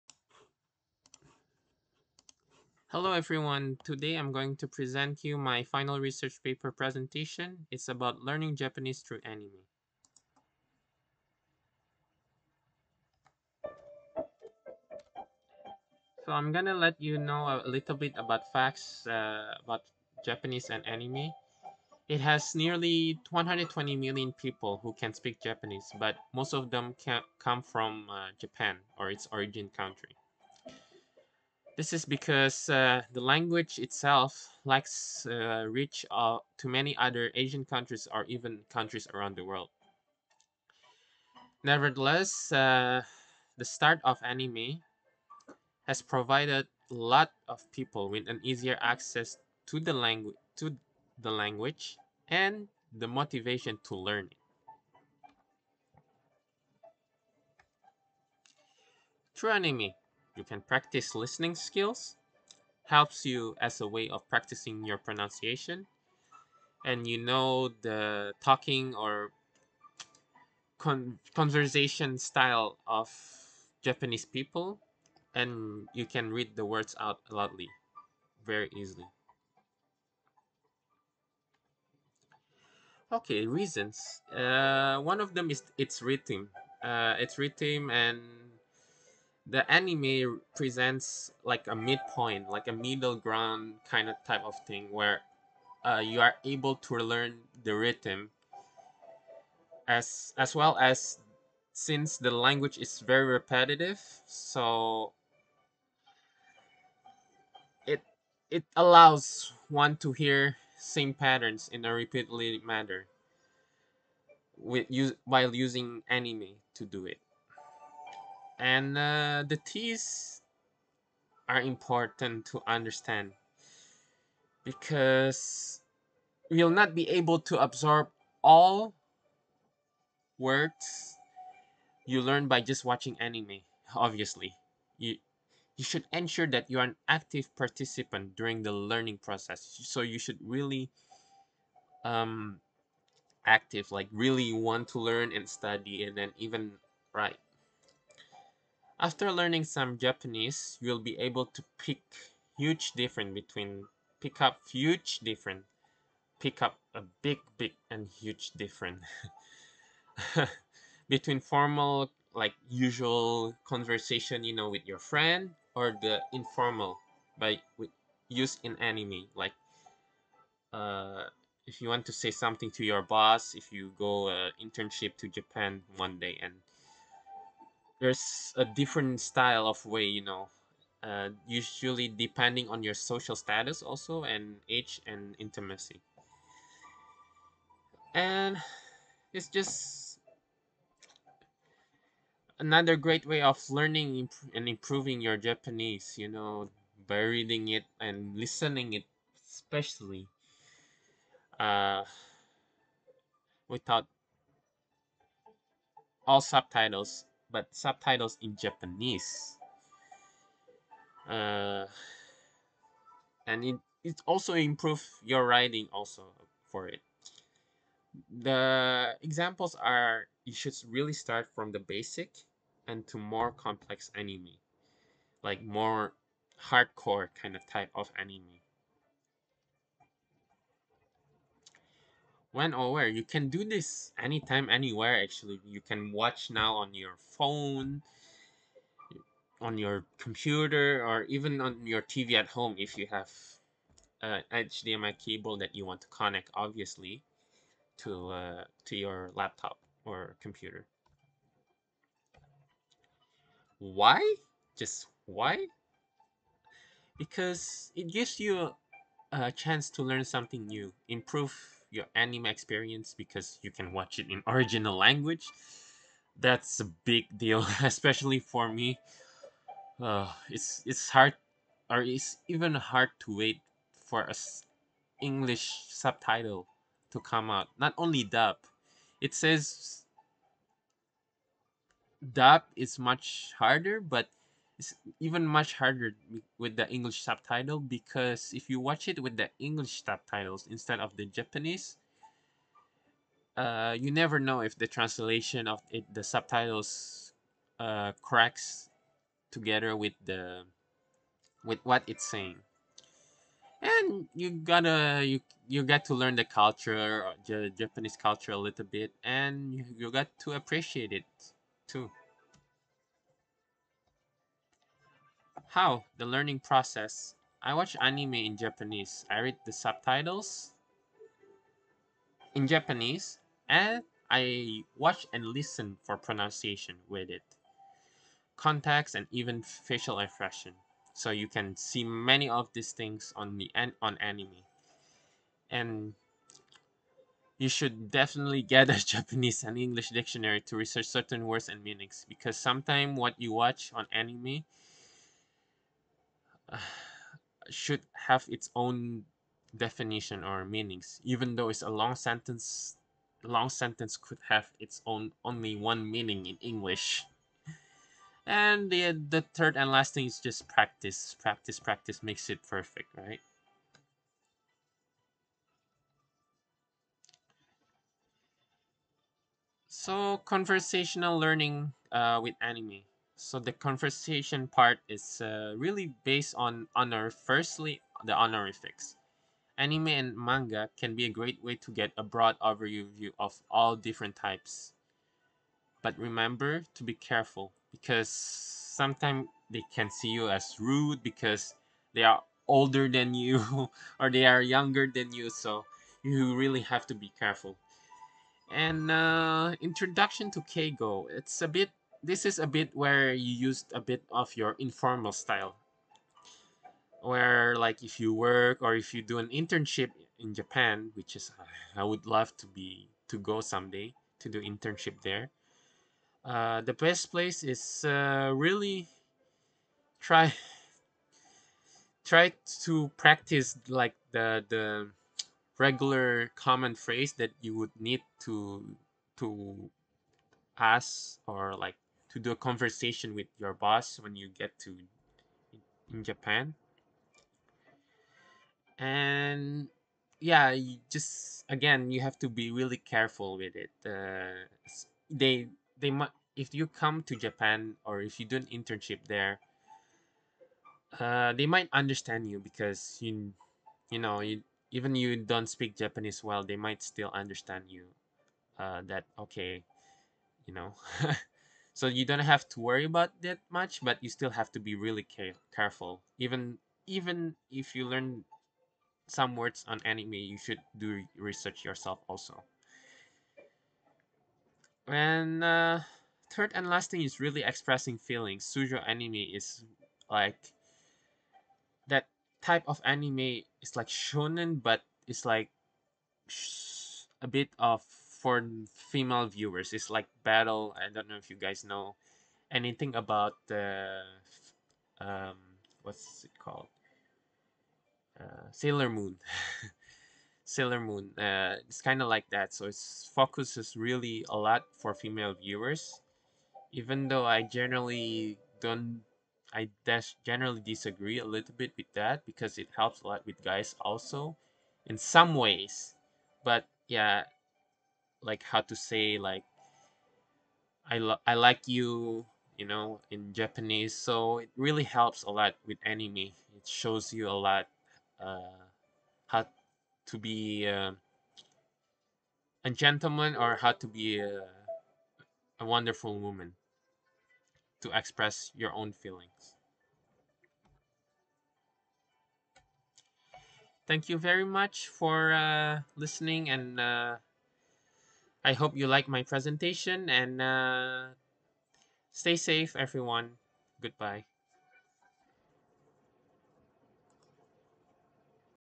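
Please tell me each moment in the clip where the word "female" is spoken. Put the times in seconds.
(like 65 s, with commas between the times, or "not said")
489 s, 505 s.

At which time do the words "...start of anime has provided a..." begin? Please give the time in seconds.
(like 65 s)
43 s.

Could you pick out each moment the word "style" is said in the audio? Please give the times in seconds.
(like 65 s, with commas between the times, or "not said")
72 s, 179 s, 405 s.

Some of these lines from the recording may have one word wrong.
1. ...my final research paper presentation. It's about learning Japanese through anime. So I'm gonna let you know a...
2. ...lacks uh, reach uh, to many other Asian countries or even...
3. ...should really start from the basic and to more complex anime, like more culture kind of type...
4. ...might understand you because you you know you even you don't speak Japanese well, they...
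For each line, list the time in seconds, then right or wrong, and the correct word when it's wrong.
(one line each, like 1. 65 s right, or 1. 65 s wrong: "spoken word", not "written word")
1. 5 s right
2. 34 s right
3. 220 s wrong: "hardcore", not "culture"
4. 451 s right.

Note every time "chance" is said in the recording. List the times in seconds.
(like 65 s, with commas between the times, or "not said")
259 s.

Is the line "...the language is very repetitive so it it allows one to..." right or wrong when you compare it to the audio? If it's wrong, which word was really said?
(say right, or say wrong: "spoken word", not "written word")
right.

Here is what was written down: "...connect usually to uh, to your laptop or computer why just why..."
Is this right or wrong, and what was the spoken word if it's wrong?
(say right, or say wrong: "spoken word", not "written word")
wrong: "obviously", not "usually".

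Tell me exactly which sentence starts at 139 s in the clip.
So you should really um, active, like really want to learn and study and then even write.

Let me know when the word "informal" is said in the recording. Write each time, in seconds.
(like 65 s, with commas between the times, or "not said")
166 s, 404 s.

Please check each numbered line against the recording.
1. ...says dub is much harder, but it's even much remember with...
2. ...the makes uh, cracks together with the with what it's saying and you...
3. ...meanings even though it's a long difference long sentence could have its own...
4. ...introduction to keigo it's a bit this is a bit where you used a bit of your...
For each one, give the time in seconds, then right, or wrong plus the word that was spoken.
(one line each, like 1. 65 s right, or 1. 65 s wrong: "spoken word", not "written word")
1. 279 s wrong: "harder", not "remember"
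2. 296 s wrong: "subtitles", not "makes"
3. 350 s wrong: "sentence", not "difference"
4. 399 s right.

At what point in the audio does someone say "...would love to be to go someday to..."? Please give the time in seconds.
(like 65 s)
412 s.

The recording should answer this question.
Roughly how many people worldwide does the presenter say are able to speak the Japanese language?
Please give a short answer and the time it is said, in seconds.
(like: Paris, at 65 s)
120 million, at 23 s.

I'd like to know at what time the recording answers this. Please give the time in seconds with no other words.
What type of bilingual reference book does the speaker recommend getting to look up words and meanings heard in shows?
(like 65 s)
339 s.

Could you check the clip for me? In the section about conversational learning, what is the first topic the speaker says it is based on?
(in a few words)
honorifics.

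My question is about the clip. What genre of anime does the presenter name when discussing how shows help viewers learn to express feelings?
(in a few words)
Shojo.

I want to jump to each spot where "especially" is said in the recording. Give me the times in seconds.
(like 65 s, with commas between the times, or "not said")
199 s, 267 s.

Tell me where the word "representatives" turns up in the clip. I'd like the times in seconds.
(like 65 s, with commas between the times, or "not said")
not said.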